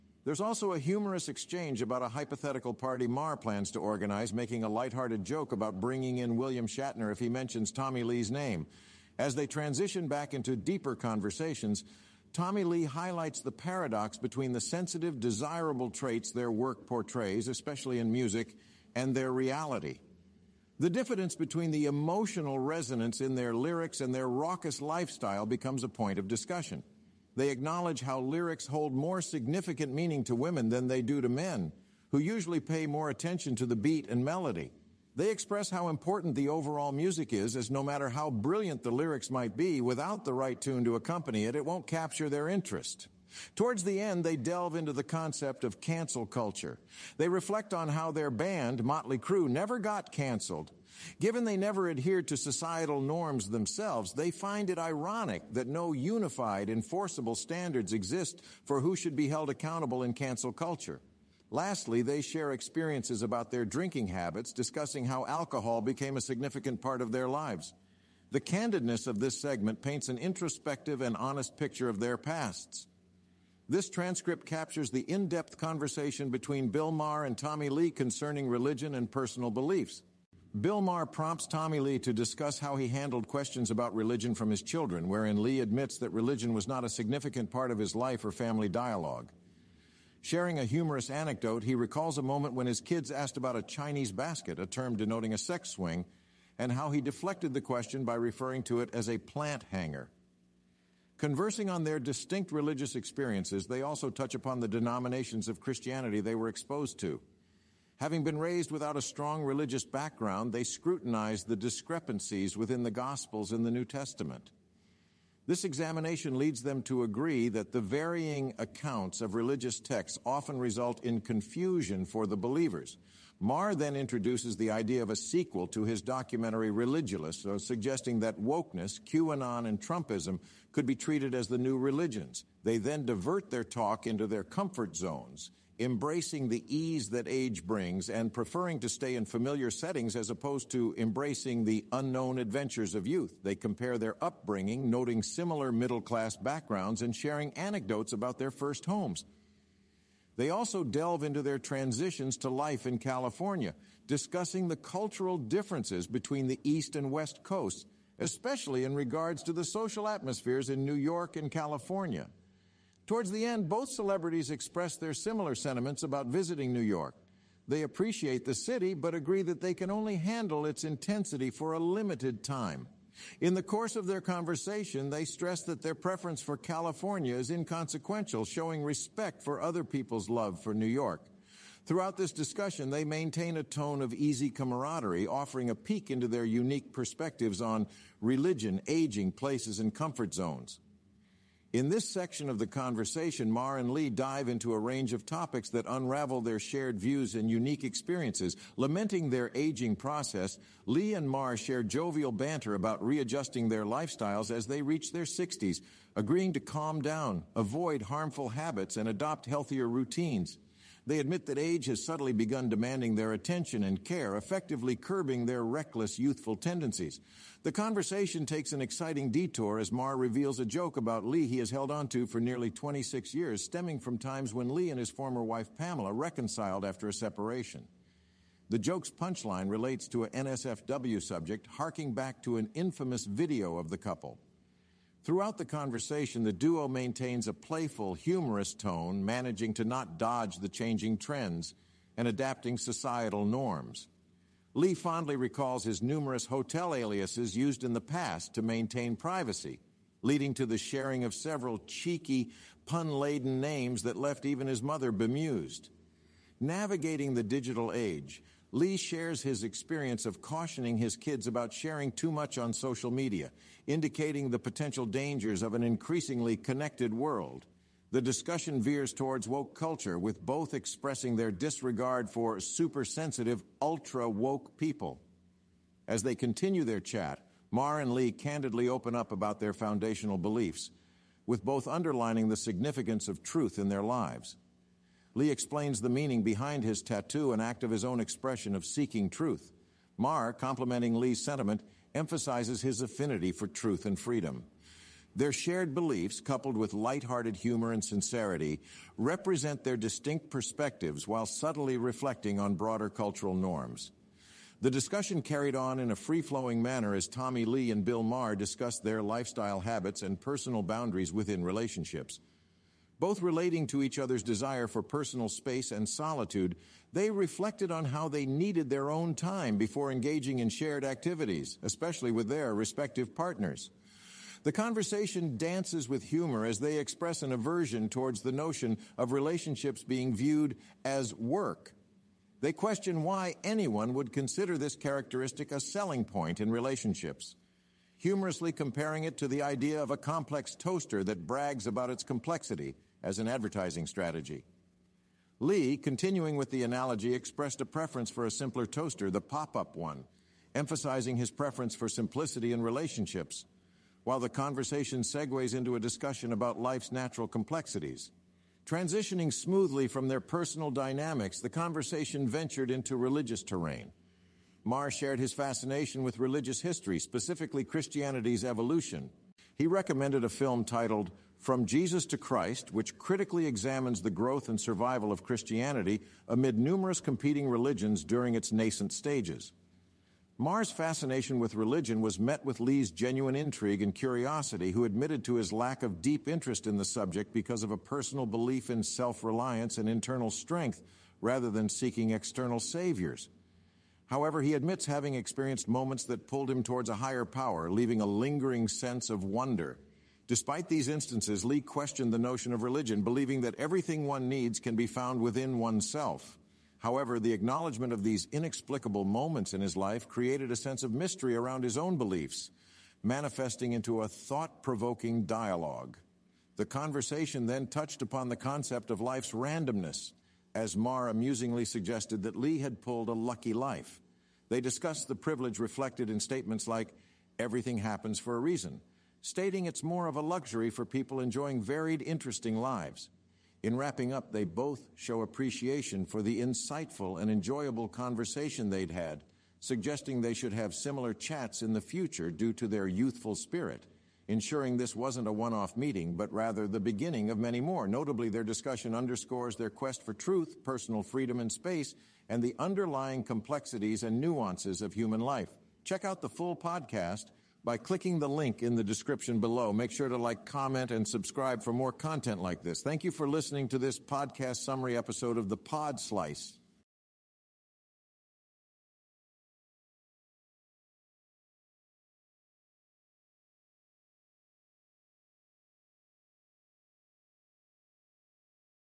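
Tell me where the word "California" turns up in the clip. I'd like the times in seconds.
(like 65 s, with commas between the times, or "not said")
152 s, 161 s, 176 s.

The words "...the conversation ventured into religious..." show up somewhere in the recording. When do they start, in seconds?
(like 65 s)
361 s.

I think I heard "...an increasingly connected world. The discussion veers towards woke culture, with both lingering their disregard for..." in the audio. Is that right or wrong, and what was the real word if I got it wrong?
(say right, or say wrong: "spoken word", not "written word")
wrong: "expressing", not "lingering".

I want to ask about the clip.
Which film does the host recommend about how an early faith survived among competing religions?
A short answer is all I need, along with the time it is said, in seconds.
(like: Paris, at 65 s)
From Jesus to Christ, at 371 s.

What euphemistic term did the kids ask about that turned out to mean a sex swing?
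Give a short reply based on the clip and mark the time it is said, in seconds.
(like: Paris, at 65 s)
Chinese basket, at 93 s.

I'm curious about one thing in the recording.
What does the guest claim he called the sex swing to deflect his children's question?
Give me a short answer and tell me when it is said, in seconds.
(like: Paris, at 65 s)
plant hanger, at 99 s.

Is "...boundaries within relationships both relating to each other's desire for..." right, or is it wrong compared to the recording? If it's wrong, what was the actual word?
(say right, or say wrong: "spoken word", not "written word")
right.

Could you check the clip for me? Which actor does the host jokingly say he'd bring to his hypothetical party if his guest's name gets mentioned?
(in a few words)
William Shatner.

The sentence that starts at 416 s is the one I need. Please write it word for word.
The conversation then touched upon the concept of life's randomness, as Maher amusingly suggested that Lee had pulled a lucky life.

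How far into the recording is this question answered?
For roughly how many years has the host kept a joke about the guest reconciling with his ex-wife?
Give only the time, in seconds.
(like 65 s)
222 s.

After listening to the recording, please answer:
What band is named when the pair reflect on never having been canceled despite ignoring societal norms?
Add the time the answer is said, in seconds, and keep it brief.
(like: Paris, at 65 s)
Motley Crue, at 48 s.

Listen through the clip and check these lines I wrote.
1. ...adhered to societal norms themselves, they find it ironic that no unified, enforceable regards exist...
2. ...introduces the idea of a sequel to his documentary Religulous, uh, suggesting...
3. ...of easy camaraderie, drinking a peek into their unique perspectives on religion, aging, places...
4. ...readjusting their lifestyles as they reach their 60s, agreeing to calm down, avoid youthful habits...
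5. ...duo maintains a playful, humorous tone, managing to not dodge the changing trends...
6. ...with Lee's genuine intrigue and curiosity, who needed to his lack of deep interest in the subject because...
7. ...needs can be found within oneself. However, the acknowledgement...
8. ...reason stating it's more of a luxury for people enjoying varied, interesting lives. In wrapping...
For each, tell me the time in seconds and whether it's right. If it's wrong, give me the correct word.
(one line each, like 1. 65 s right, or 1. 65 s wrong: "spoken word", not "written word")
1. 51 s wrong: "standards", not "regards"
2. 123 s right
3. 184 s wrong: "offering", not "drinking"
4. 203 s wrong: "harmful", not "youthful"
5. 236 s right
6. 382 s wrong: "admitted", not "needed"
7. 404 s right
8. 428 s right.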